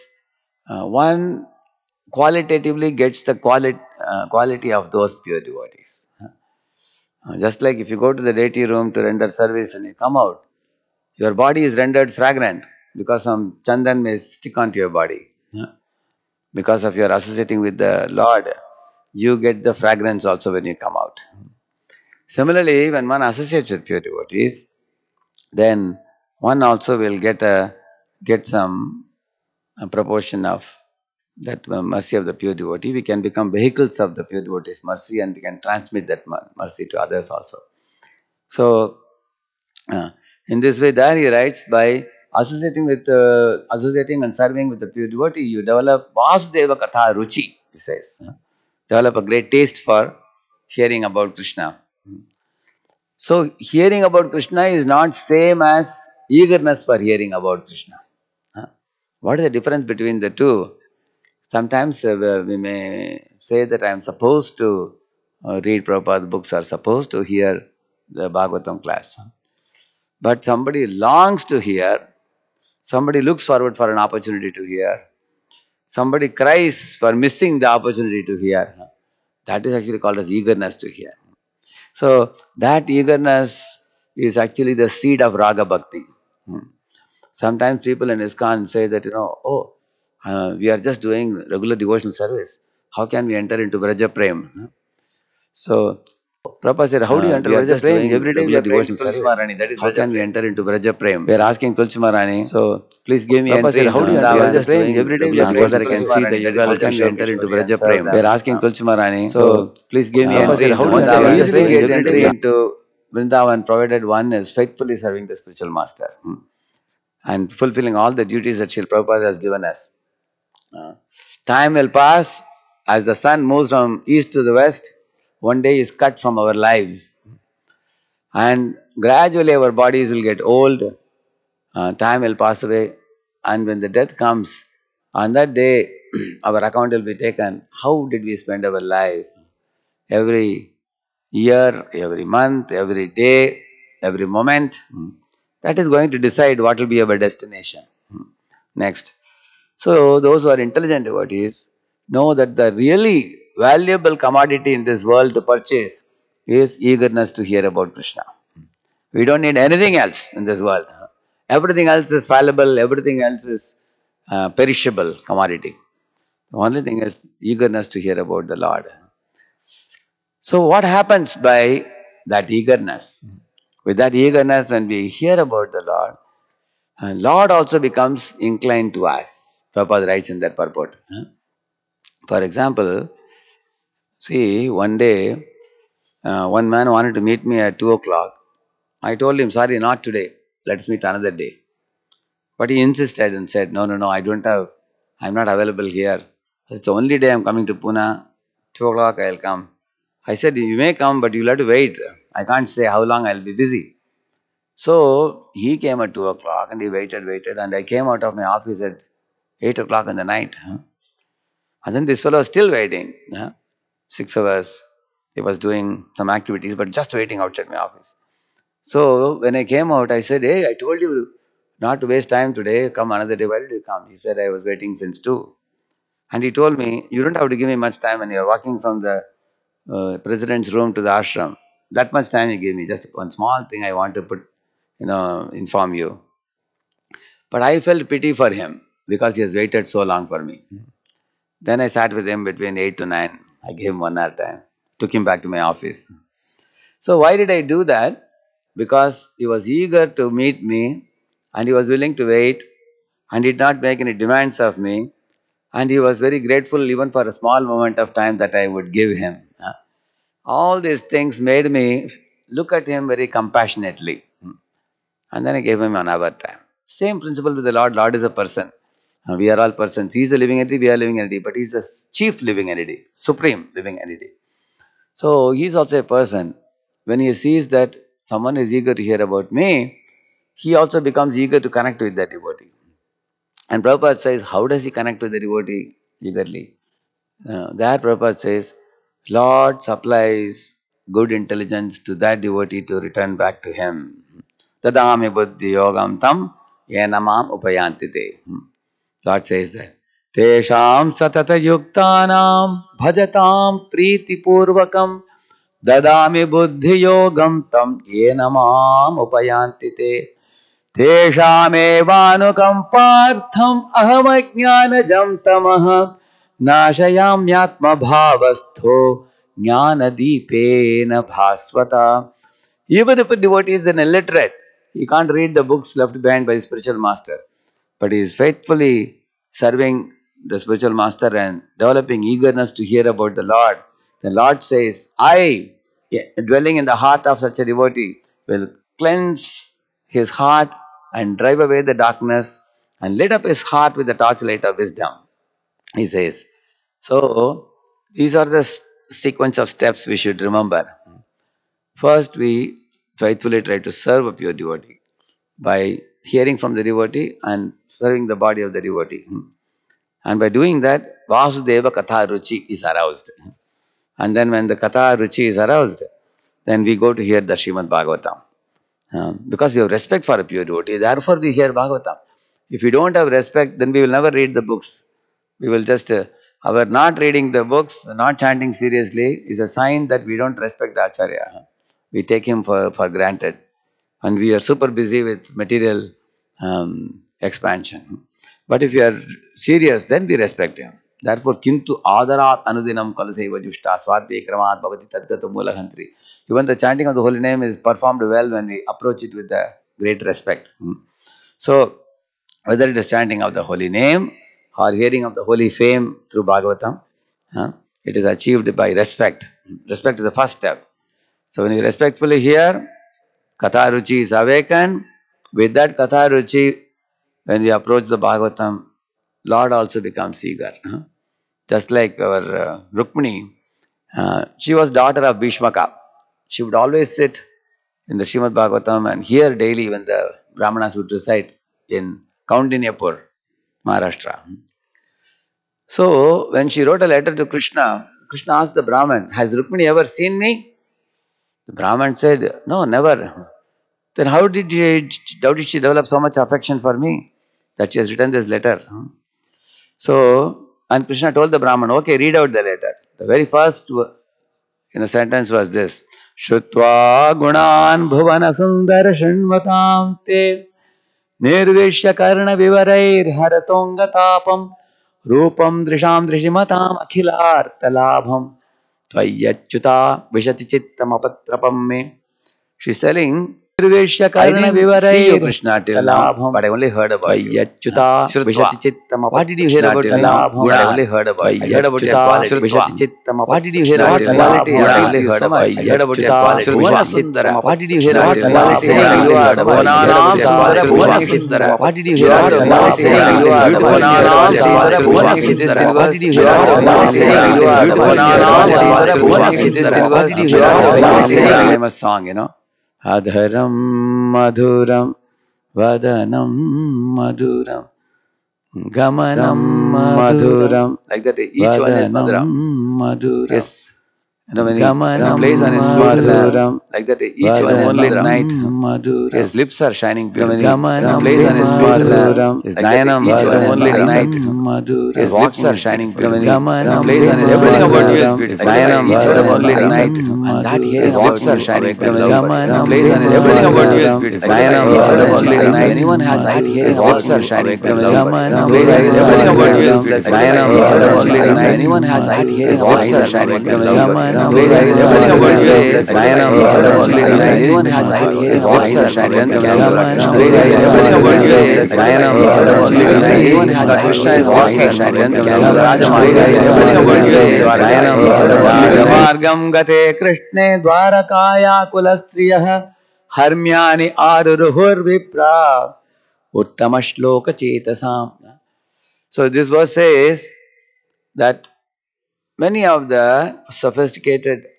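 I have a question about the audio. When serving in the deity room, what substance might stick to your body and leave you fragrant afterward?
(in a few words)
Chandan.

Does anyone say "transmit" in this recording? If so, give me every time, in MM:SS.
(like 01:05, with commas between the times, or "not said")
00:35.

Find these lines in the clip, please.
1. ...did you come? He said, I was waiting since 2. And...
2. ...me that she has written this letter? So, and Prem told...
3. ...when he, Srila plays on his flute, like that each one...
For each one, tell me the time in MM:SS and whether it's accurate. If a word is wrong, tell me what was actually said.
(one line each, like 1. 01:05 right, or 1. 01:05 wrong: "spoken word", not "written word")
1. 03:43 right
2. 07:26 wrong: "Krishna", not "Prem"
3. 08:34 wrong: "Ram", not "Srila".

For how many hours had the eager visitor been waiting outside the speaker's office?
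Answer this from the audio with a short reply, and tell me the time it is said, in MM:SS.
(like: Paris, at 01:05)
6, at 03:34.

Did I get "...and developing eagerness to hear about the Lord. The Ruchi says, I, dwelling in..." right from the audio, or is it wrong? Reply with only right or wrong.
wrong.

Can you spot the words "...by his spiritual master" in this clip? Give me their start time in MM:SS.
05:26.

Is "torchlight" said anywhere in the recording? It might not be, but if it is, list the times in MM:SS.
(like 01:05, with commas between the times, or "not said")
05:44.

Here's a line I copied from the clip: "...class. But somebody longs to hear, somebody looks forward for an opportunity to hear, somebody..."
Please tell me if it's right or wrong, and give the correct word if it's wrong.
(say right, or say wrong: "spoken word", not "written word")
right.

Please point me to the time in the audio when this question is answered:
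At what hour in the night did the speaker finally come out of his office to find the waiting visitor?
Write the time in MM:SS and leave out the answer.
03:29.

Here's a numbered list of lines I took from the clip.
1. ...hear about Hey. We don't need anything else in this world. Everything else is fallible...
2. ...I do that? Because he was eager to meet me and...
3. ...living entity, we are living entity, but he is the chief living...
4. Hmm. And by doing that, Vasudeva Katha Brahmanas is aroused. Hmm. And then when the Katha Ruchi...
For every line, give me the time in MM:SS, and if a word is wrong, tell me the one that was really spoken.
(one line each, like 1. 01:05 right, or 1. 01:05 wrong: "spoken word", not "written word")
1. 02:37 wrong: "Krishna", not "Hey"
2. 04:07 right
3. 04:30 right
4. 05:59 wrong: "Ruchi", not "Brahmanas".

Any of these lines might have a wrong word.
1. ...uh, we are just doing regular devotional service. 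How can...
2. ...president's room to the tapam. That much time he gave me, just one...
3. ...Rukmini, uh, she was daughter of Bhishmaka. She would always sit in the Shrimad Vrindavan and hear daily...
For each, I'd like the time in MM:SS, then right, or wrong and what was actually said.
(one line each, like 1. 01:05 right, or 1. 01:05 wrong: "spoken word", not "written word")
1. 01:30 right
2. 03:50 wrong: "ashram", not "tapam"
3. 07:02 wrong: "Bhagavatam", not "Vrindavan".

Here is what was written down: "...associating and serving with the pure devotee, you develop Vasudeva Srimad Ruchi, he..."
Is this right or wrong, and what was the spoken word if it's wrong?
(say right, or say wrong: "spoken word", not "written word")
wrong: "Katha", not "Srimad".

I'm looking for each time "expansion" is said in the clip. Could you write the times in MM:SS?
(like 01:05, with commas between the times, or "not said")
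06:27.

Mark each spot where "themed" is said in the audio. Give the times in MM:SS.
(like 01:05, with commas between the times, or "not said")
not said.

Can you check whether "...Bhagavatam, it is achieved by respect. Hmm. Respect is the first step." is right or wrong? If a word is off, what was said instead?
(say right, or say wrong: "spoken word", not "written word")
right.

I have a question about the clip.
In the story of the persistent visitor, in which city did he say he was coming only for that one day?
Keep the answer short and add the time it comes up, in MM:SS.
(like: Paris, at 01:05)
Pune, at 03:17.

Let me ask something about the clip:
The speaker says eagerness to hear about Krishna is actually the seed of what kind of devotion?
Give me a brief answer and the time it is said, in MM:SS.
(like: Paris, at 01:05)
Raga bhakti, at 01:25.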